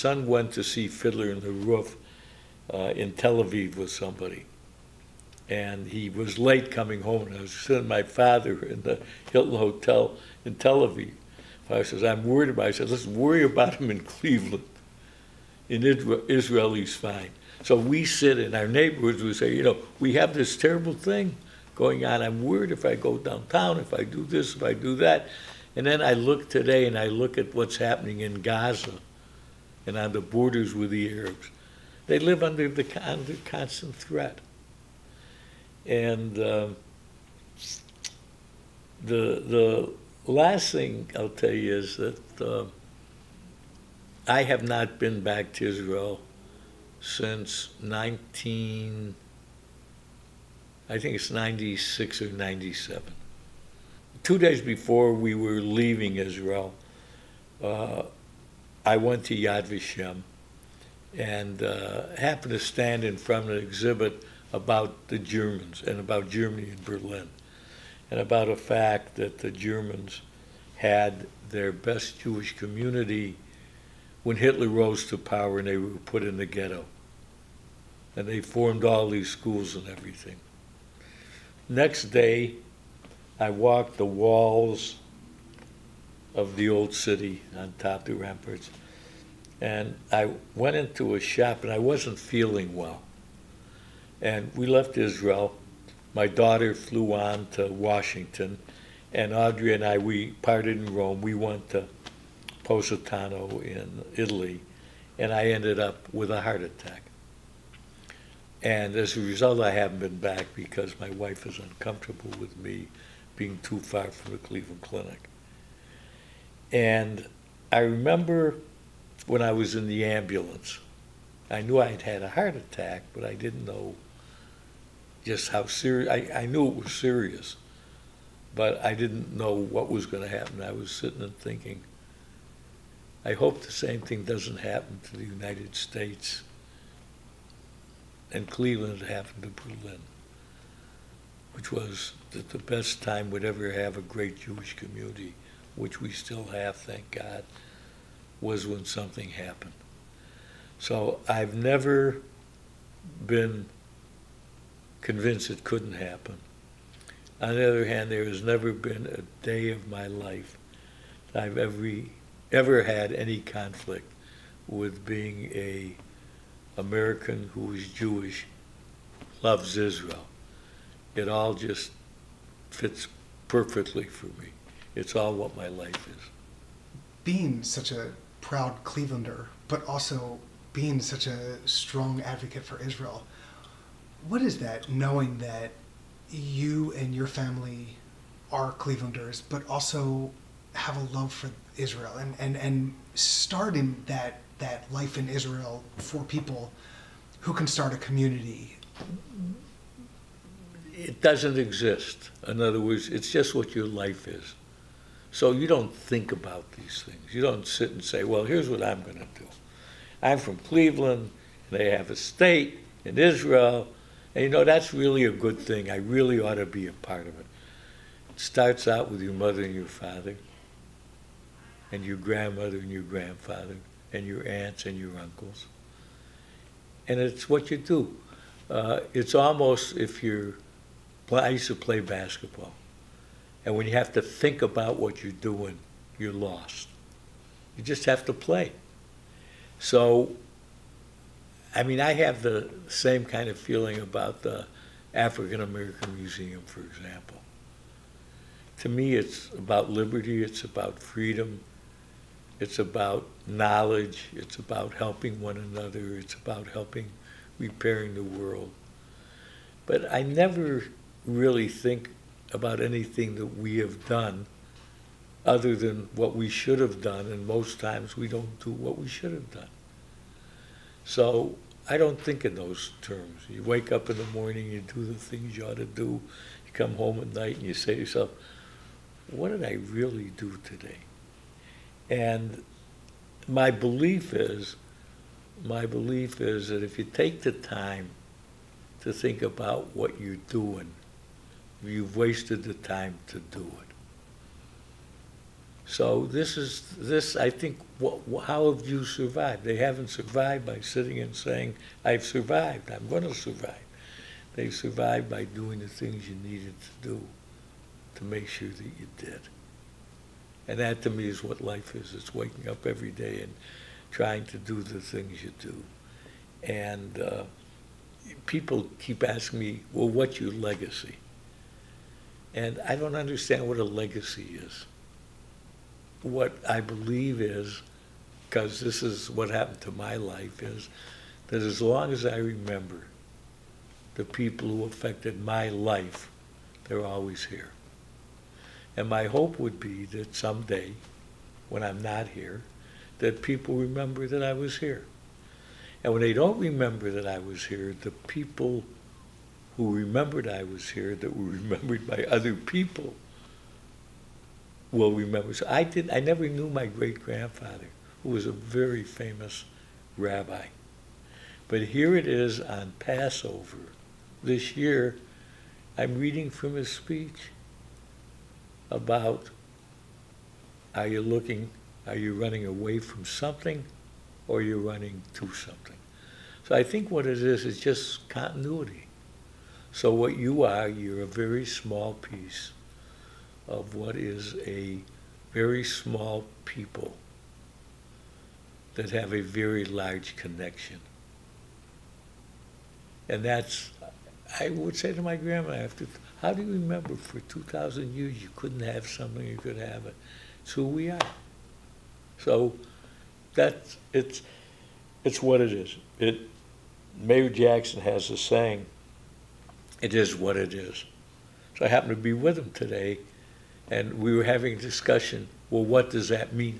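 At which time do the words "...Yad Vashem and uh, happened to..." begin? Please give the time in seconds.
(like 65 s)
59 s.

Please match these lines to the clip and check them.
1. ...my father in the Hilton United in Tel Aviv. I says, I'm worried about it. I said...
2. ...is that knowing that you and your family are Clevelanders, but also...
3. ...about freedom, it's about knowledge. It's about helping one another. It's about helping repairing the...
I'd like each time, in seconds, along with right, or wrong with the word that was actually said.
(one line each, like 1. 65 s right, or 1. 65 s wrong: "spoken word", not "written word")
1. 7 s wrong: "Hotel", not "United"
2. 184 s right
3. 250 s right.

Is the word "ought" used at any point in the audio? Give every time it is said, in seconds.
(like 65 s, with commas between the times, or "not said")
216 s, 275 s.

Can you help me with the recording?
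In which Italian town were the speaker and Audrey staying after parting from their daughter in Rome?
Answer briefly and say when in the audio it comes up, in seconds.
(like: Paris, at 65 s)
Positano, at 102 s.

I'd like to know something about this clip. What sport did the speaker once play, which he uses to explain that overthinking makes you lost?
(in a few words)
basketball.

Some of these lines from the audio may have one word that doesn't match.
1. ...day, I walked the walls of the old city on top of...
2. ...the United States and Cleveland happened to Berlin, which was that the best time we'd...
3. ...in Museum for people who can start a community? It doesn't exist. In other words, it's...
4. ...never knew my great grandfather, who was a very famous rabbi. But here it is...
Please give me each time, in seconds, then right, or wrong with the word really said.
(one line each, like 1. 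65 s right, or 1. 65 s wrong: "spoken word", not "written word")
1. 82 s right
2. 135 s right
3. 195 s wrong: "Israel", not "Museum"
4. 356 s right.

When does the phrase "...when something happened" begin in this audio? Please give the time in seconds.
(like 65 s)
148 s.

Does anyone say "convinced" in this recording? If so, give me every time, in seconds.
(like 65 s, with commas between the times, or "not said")
154 s.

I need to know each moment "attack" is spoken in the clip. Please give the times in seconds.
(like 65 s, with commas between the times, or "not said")
106 s, 122 s.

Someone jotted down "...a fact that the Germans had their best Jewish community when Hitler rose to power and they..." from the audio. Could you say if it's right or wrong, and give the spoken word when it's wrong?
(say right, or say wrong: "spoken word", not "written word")
right.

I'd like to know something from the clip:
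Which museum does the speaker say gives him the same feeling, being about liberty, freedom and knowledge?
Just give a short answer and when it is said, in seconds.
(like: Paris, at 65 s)
African American Museum, at 245 s.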